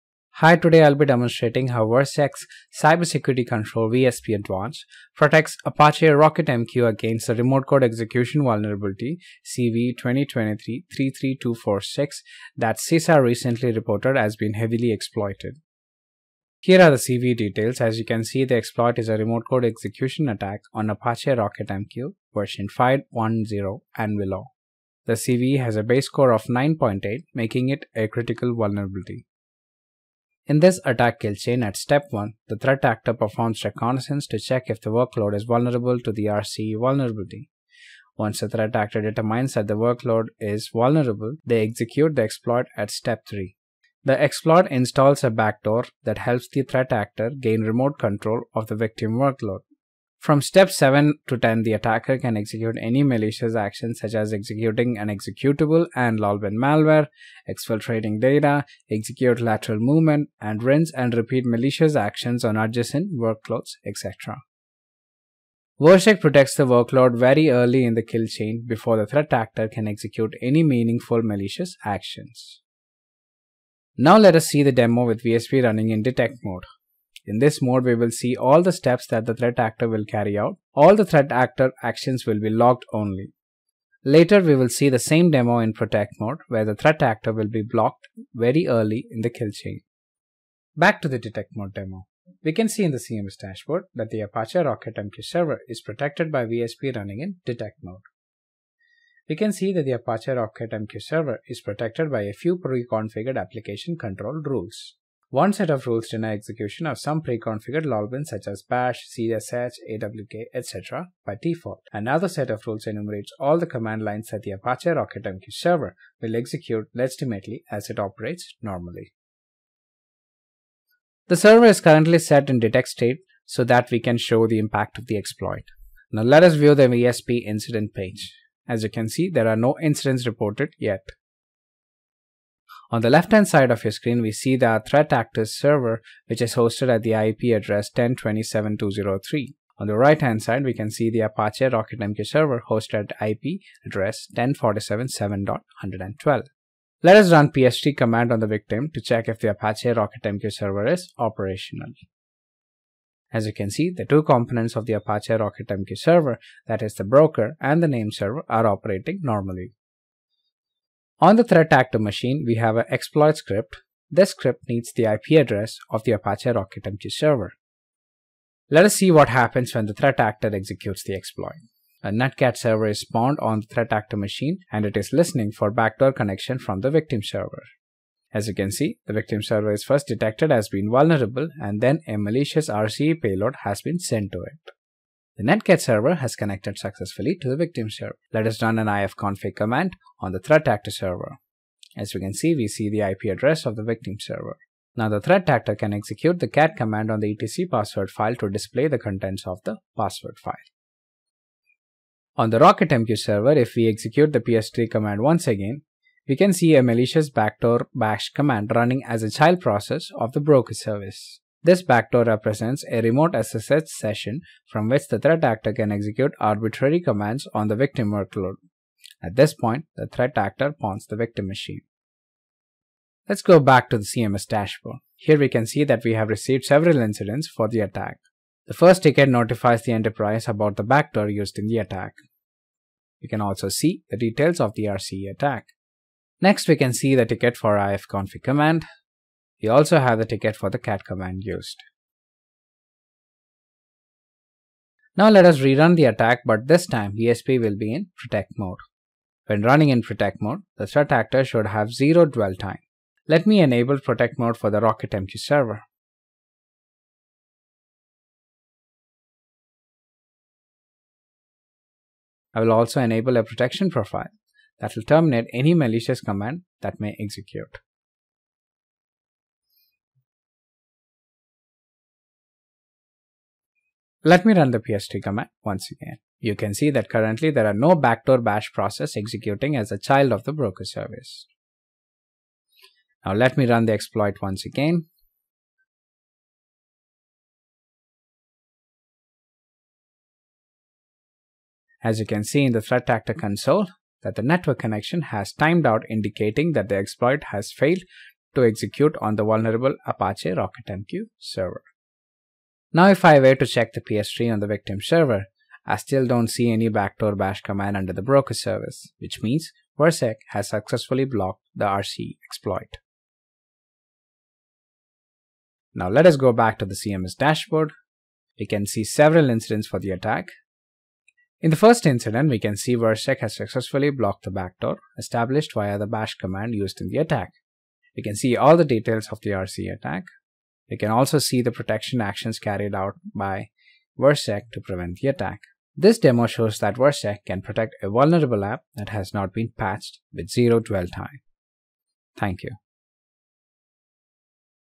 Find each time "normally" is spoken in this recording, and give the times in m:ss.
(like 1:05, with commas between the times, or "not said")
1:58, 2:39.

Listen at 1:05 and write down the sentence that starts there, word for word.
Virsec protects the workload very early in the kill chain before the threat actor can execute any meaningful malicious actions.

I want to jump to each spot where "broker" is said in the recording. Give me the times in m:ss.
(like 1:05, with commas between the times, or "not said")
2:37, 3:30, 4:40, 5:08.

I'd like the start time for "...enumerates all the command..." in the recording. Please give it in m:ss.
1:52.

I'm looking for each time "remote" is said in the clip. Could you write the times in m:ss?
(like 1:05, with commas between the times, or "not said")
0:07, 0:19, 0:47, 3:33.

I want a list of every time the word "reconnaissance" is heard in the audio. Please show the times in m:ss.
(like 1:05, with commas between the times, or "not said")
0:33.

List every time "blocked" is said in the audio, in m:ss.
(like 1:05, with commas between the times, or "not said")
1:27, 5:11, 5:24.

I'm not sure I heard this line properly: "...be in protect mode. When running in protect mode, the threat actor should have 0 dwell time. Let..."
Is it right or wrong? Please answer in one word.
right.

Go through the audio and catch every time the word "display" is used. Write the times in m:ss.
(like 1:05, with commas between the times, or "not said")
3:18.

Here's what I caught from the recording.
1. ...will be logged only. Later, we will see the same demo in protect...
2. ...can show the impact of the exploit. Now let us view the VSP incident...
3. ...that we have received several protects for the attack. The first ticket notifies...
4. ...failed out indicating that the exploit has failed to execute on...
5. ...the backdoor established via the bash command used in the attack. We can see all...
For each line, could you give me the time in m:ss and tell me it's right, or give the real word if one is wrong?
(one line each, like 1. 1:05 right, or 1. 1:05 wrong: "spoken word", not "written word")
1. 1:22 right
2. 2:04 right
3. 3:45 wrong: "incidents", not "protects"
4. 4:55 wrong: "timed", not "failed"
5. 5:24 right.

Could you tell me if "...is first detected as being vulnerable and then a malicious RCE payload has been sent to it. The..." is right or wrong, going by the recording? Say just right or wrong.
right.